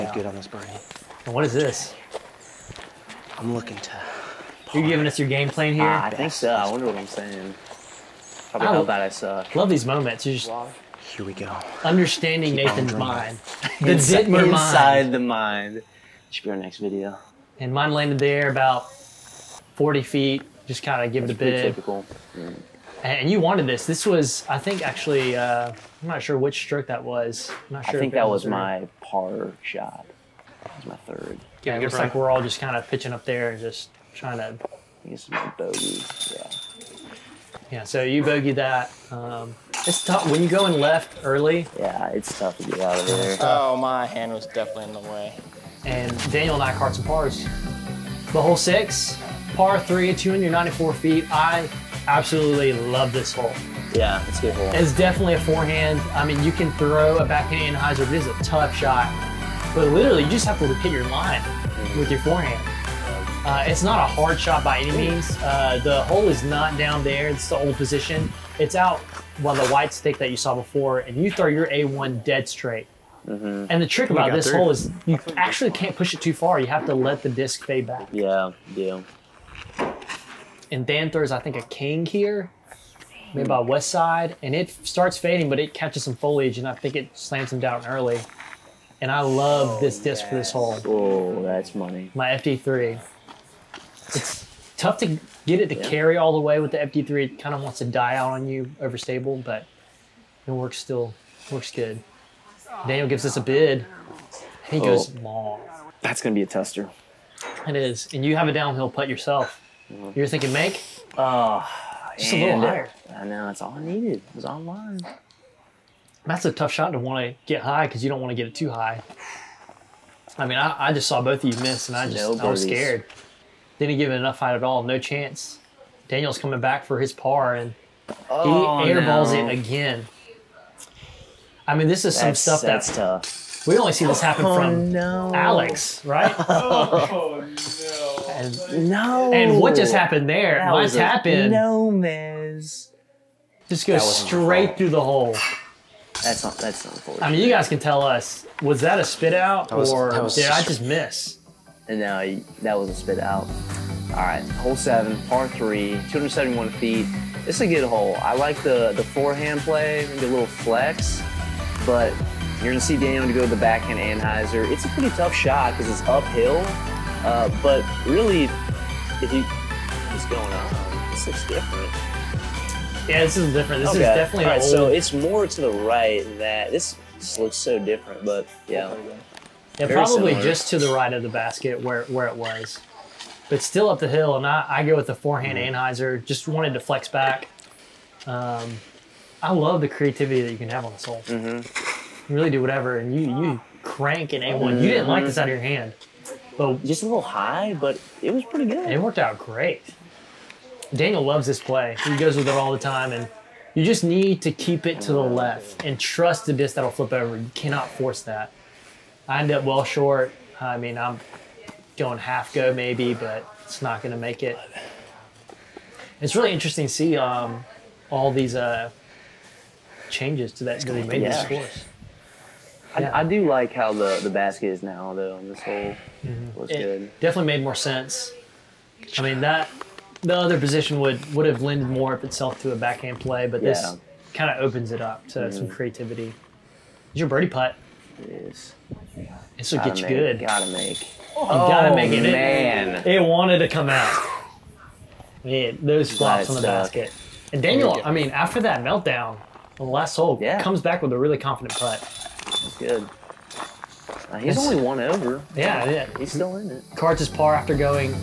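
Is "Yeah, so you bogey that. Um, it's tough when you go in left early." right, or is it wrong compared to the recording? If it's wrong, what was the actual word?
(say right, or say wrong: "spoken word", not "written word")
right.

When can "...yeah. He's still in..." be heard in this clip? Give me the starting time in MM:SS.
04:15.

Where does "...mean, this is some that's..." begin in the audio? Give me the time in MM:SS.
02:11.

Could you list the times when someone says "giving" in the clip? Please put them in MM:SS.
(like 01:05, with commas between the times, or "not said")
00:04.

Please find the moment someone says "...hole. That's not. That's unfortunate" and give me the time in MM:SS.
02:25.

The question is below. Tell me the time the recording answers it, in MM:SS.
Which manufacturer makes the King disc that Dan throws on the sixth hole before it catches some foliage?
01:23.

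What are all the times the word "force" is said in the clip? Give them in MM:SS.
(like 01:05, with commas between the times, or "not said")
03:27.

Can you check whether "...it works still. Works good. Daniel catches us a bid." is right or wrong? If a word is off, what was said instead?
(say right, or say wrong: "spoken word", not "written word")
wrong: "gives", not "catches".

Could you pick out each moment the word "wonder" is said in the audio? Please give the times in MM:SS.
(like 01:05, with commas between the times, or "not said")
00:06.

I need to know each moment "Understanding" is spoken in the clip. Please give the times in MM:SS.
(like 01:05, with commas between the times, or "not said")
00:11.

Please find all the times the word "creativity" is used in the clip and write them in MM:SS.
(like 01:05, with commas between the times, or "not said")
03:09, 03:55.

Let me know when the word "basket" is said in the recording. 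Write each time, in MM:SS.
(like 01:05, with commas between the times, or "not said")
03:01, 03:44, 04:06.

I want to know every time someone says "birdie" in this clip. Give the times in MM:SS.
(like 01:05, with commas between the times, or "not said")
00:00, 03:57.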